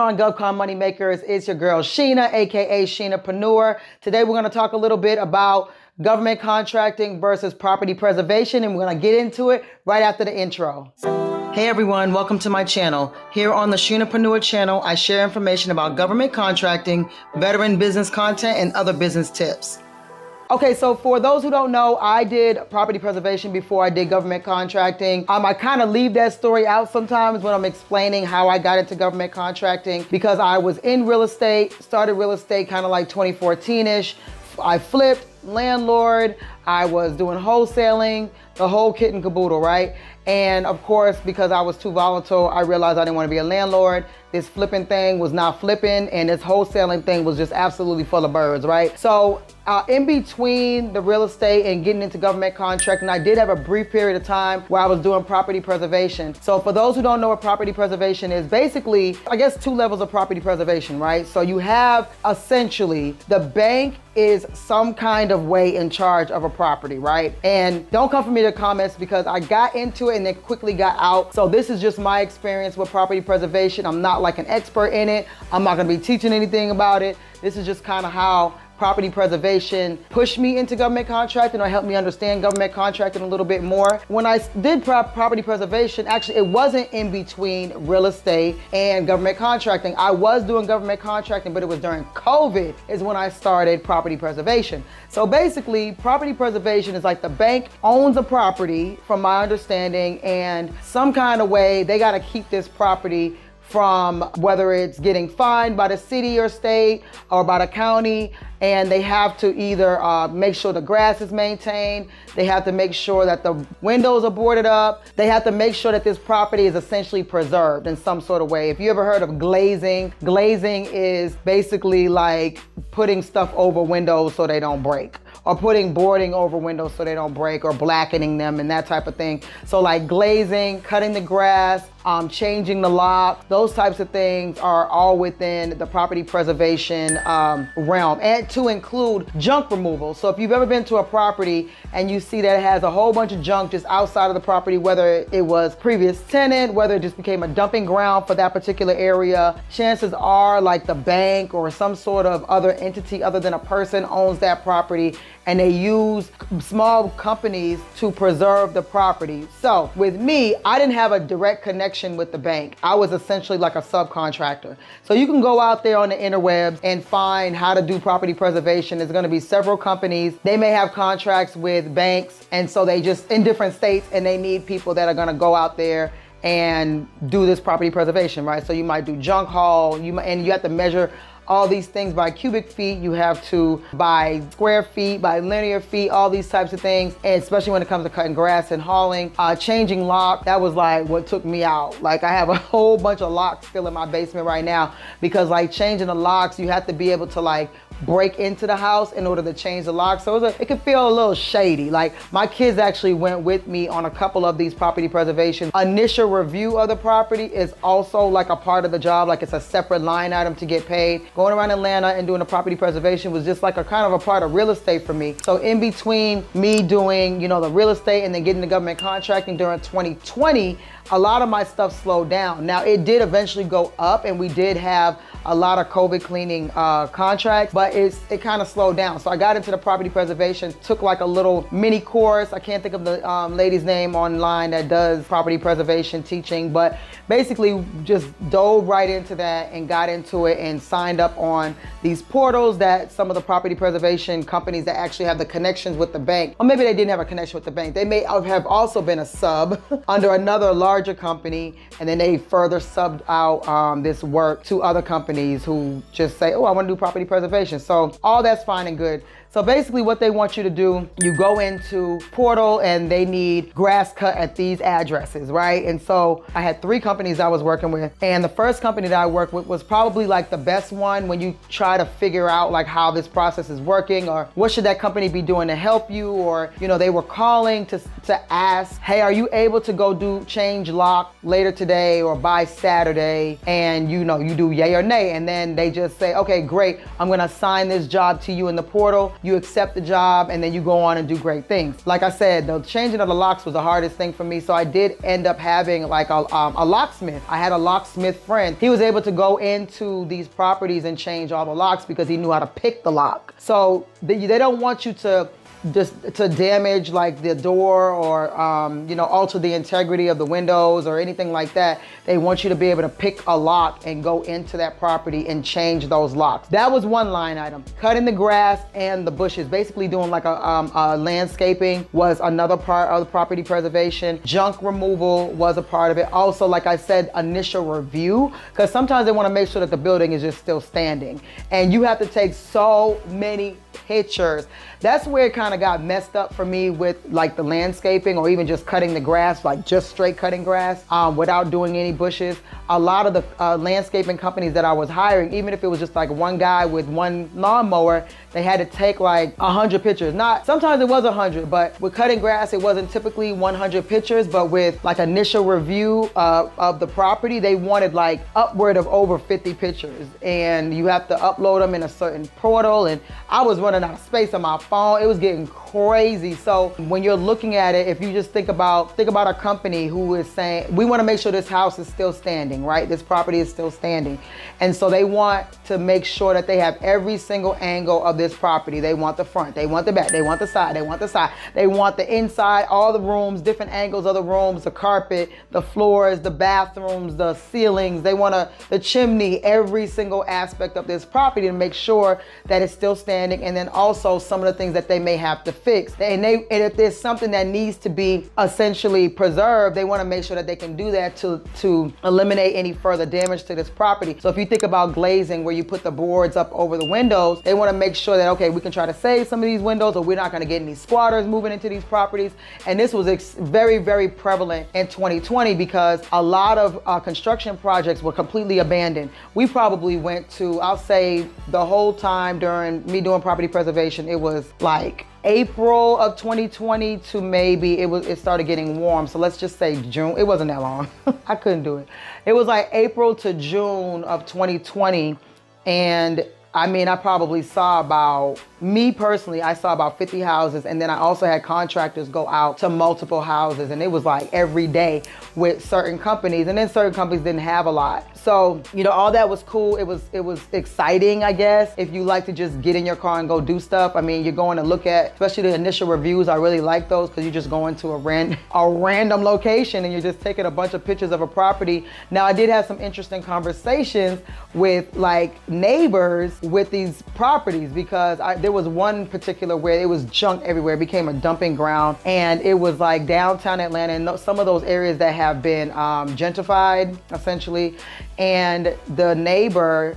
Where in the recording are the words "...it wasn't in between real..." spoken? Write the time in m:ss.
1:26.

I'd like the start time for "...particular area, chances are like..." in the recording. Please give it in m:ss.
2:28.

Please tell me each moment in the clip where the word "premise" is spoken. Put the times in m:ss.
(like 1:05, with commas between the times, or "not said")
not said.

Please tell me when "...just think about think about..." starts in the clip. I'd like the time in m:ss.
6:08.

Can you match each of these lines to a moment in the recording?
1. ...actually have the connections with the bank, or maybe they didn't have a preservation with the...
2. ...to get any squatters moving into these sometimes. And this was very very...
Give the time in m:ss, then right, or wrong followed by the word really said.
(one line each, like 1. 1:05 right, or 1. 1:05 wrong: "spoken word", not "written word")
1. 4:04 wrong: "connection", not "preservation"
2. 6:50 wrong: "properties", not "sometimes".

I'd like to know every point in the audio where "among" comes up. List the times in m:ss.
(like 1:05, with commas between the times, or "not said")
not said.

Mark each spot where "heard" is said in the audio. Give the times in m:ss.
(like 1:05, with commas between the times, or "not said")
1:59.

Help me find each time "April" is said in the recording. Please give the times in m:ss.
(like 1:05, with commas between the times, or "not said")
7:05, 7:12.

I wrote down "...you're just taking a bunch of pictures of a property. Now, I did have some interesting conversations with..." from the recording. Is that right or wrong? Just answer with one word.
right.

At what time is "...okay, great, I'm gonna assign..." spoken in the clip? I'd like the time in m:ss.
4:46.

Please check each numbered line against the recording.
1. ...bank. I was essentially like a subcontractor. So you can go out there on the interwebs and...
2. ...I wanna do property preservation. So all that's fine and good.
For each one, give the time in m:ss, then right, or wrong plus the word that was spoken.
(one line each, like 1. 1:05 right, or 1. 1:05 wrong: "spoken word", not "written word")
1. 2:42 right
2. 4:16 right.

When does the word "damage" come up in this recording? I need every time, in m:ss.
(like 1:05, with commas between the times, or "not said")
5:06, 6:43.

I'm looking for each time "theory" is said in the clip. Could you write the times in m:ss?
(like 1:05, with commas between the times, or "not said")
not said.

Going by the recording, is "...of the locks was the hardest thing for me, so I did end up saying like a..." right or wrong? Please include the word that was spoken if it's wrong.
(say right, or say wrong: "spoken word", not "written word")
wrong: "having", not "saying".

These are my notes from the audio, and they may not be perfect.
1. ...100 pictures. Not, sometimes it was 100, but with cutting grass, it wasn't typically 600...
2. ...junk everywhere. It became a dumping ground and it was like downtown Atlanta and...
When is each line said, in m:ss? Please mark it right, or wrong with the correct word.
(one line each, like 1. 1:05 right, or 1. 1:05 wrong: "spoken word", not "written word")
1. 5:49 wrong: "100", not "600"
2. 7:50 right.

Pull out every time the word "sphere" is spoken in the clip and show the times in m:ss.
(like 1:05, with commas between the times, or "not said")
not said.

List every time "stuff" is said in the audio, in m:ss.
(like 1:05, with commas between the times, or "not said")
2:03, 3:41, 7:33.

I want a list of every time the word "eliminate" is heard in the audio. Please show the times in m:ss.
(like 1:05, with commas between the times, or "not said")
6:42.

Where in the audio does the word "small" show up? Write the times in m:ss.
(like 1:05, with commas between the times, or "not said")
2:36.